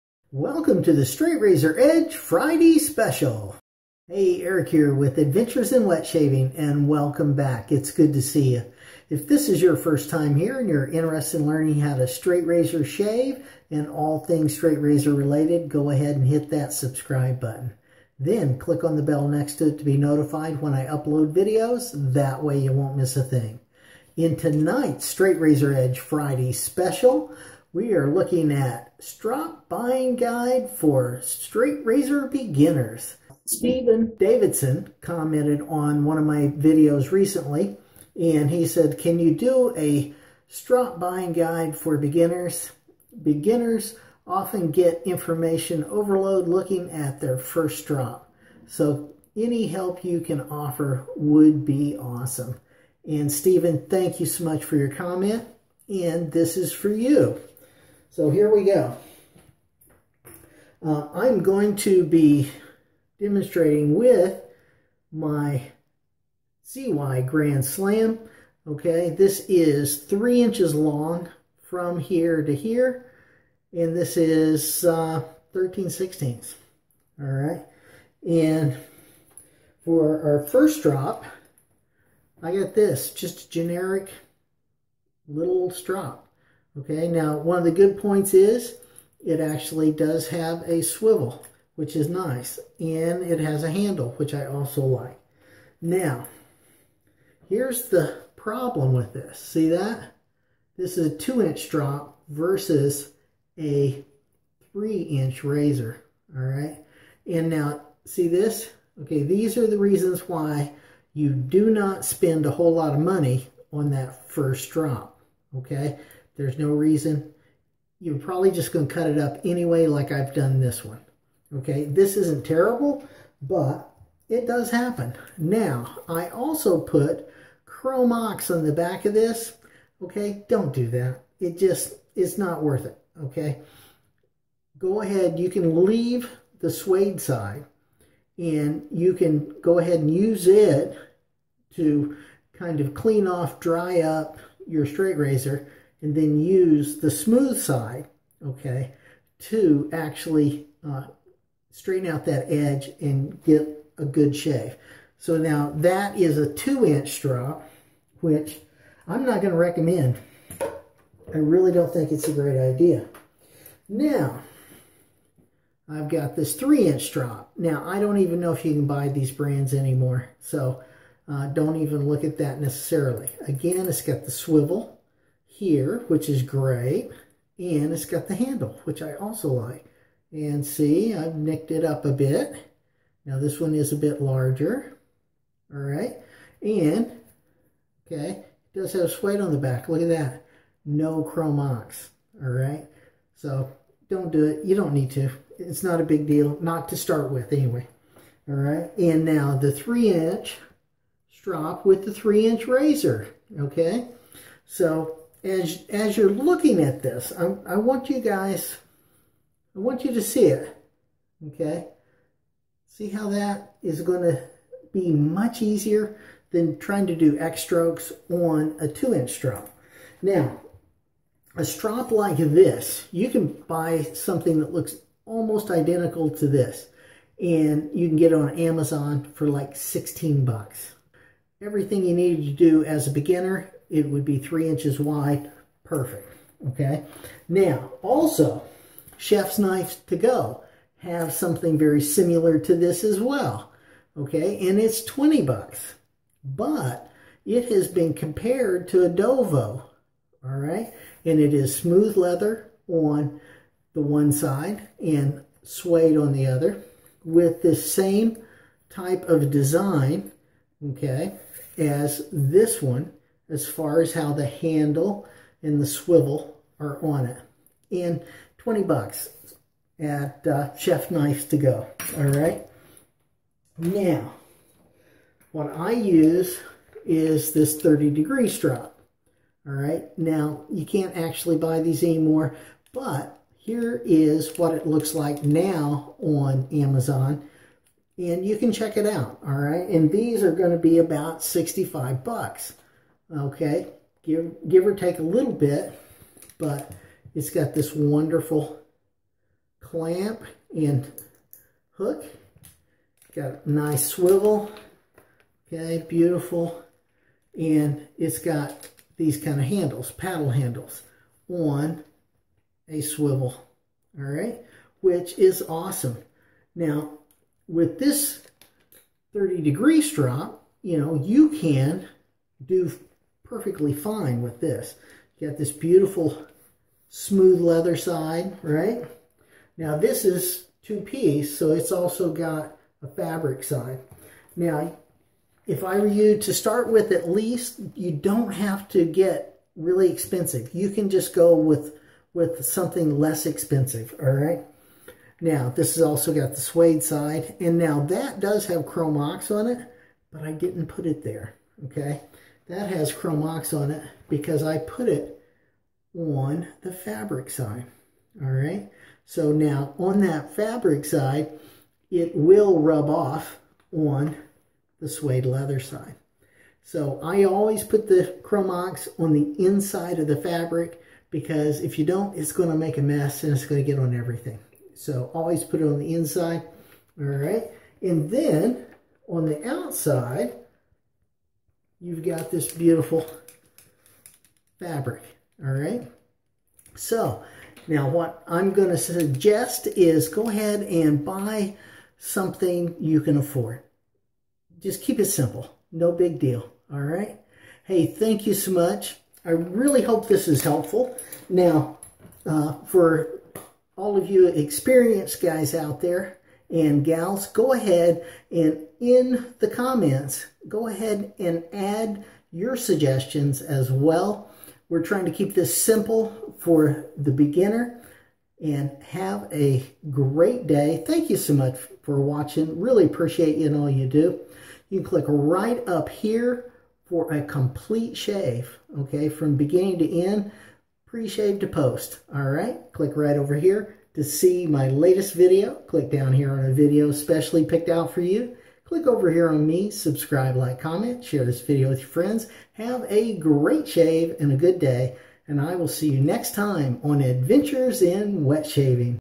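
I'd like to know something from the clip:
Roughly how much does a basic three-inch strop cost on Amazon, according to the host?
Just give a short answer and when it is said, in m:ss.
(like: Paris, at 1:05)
$16, at 3:49.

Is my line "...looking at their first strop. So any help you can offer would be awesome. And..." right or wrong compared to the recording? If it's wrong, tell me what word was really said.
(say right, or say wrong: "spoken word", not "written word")
right.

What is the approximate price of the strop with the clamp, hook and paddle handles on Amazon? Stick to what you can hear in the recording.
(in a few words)
$65.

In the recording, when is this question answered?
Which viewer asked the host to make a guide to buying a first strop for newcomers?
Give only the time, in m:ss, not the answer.
0:33.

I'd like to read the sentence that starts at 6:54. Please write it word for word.
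We're trying to keep this simple for the beginner and have a great day.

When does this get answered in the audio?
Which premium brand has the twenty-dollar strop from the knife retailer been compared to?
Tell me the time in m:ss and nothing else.
4:09.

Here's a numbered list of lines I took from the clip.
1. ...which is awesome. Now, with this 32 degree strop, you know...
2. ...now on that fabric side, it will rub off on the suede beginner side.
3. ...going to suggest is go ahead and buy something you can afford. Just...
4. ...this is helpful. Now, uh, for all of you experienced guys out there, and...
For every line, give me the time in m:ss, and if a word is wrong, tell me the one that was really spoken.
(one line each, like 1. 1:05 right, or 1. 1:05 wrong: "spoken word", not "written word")
1. 5:15 wrong: "30", not "32"
2. 5:59 wrong: "leather", not "beginner"
3. 6:28 right
4. 6:40 right.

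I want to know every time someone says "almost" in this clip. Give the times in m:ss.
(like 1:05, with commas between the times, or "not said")
3:45.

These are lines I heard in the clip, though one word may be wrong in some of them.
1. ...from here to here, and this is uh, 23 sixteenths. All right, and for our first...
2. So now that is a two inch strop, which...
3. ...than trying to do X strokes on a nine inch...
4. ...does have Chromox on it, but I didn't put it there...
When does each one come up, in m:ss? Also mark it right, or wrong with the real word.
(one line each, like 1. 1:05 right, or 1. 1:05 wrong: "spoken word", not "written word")
1. 1:11 wrong: "13", not "23"
2. 2:35 right
3. 3:36 wrong: "two", not "nine"
4. 5:48 right.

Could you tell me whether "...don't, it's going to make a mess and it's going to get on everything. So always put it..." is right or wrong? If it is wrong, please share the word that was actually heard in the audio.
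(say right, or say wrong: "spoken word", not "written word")
right.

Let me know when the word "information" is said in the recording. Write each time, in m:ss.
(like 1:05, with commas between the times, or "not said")
0:45.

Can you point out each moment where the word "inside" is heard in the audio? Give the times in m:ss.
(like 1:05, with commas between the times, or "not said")
6:09, 6:16.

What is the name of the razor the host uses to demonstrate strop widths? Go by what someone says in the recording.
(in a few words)
CY Grand Slam.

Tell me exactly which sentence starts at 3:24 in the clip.
So as, as you're looking at this, I, I want you guys, I want you to see it, okay?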